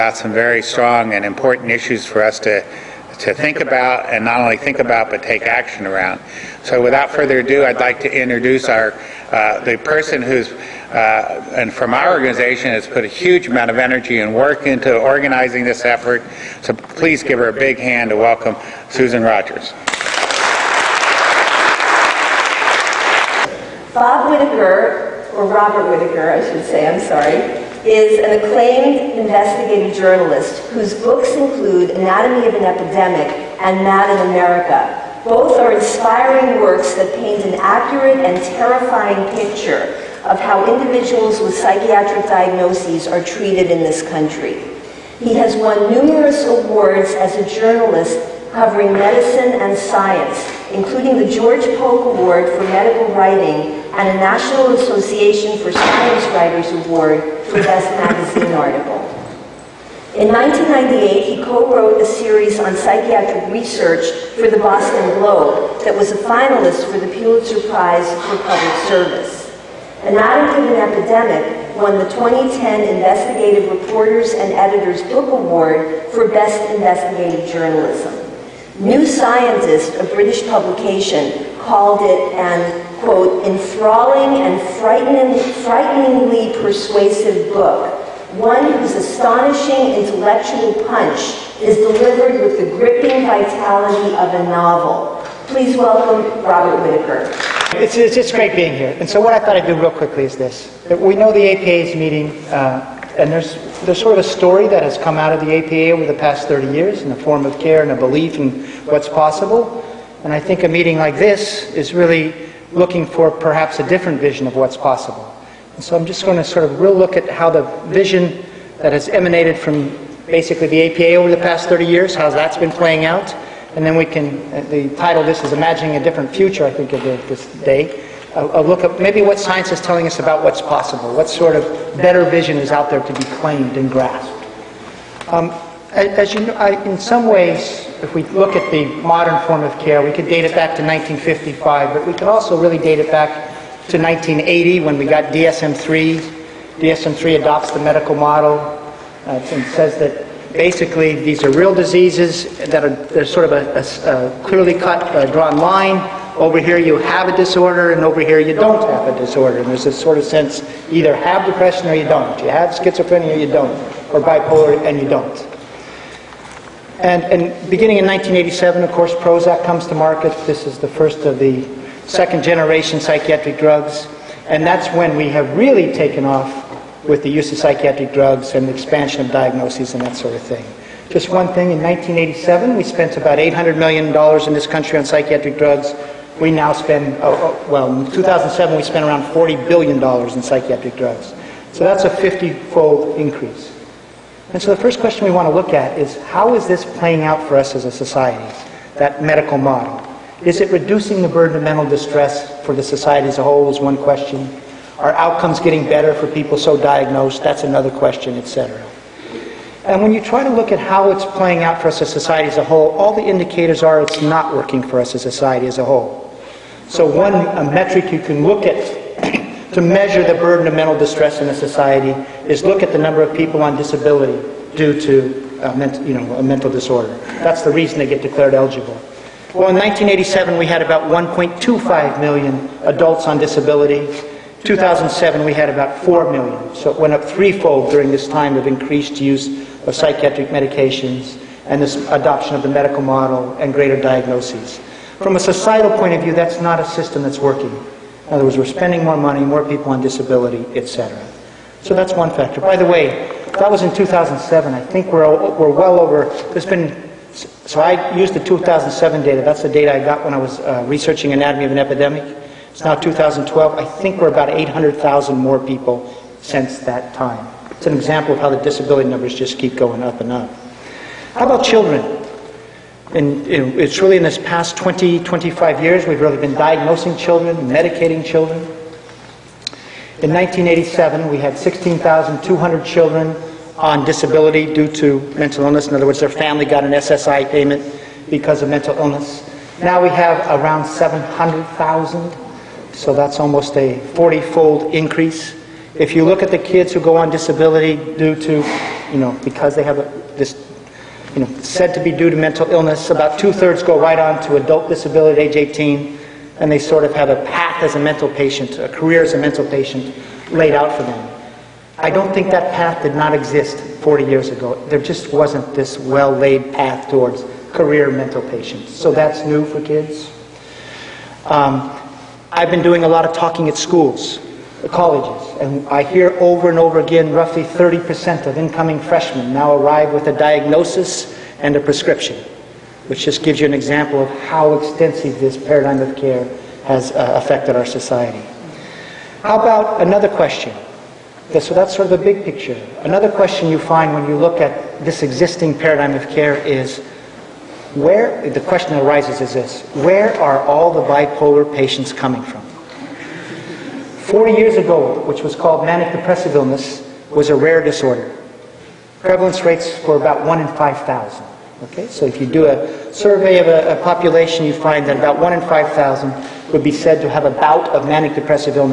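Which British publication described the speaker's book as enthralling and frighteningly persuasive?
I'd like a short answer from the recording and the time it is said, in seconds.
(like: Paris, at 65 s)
New Scientist, at 78 s.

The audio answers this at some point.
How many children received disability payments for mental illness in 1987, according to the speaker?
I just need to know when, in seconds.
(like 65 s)
281 s.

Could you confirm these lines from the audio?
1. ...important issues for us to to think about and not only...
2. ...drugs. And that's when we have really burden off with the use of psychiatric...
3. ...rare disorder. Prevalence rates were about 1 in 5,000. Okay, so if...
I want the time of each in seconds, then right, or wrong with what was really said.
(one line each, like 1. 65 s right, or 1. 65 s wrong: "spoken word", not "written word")
1. 1 s right
2. 173 s wrong: "taken", not "burden"
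3. 357 s right.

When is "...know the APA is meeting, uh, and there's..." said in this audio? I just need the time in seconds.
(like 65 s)
101 s.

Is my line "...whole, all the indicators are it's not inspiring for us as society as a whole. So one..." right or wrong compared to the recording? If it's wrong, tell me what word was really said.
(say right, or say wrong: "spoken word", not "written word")
wrong: "working", not "inspiring".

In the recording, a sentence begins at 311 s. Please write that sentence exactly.
I don't think that path did not exist 40 years ago.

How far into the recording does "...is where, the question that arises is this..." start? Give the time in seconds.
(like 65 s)
346 s.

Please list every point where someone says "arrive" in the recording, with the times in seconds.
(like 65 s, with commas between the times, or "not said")
329 s.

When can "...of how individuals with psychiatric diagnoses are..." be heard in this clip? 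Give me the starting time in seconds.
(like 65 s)
40 s.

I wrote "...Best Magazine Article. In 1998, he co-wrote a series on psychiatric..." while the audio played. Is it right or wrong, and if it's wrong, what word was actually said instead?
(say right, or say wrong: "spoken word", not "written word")
right.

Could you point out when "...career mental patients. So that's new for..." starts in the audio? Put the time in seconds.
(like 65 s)
317 s.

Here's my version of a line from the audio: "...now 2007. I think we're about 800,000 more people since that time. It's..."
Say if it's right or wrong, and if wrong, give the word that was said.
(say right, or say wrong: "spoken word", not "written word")
wrong: "2012", not "2007".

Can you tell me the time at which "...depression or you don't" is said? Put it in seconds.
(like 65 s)
161 s.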